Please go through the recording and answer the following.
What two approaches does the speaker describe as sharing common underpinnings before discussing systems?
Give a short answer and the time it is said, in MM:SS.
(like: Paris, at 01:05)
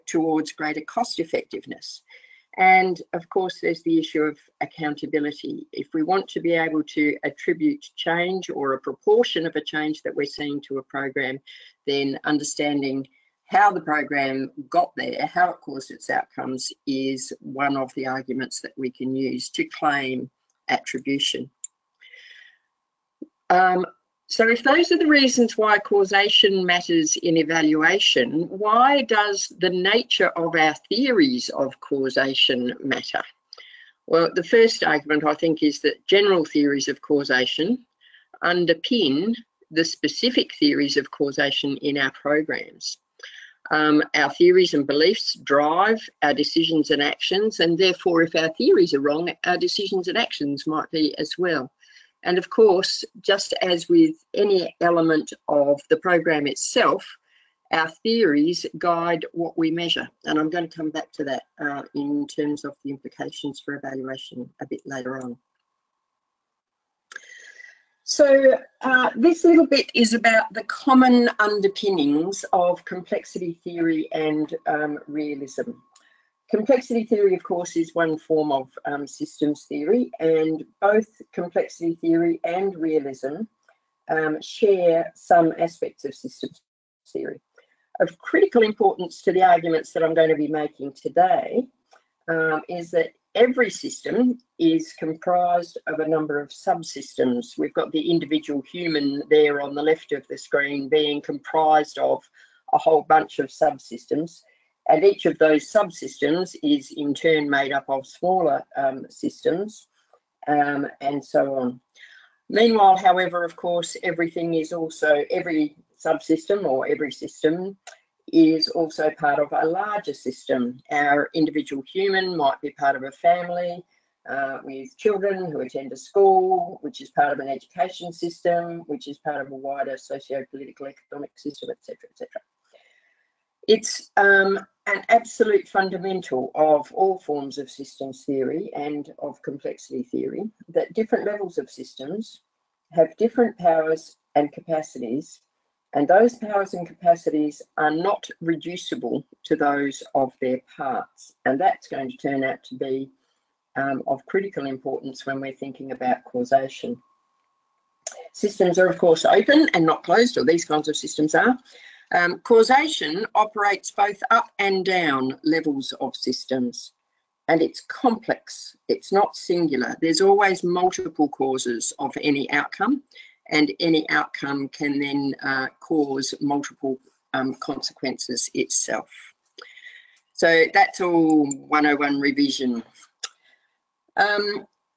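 complexity theory and realism, at 01:12.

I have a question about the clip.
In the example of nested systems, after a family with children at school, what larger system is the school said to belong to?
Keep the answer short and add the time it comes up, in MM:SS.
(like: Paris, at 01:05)
an education system, at 02:07.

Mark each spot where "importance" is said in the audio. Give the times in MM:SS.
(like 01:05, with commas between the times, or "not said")
01:28, 02:34.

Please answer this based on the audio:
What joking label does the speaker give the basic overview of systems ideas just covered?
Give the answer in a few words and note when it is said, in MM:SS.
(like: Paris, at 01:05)
101 revision, at 03:01.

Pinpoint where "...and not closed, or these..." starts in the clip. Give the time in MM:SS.
02:39.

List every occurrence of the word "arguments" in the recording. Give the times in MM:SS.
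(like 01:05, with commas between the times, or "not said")
00:18, 00:34, 01:29.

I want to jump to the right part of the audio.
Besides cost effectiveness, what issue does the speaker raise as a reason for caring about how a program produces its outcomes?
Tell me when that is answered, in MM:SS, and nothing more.
00:04.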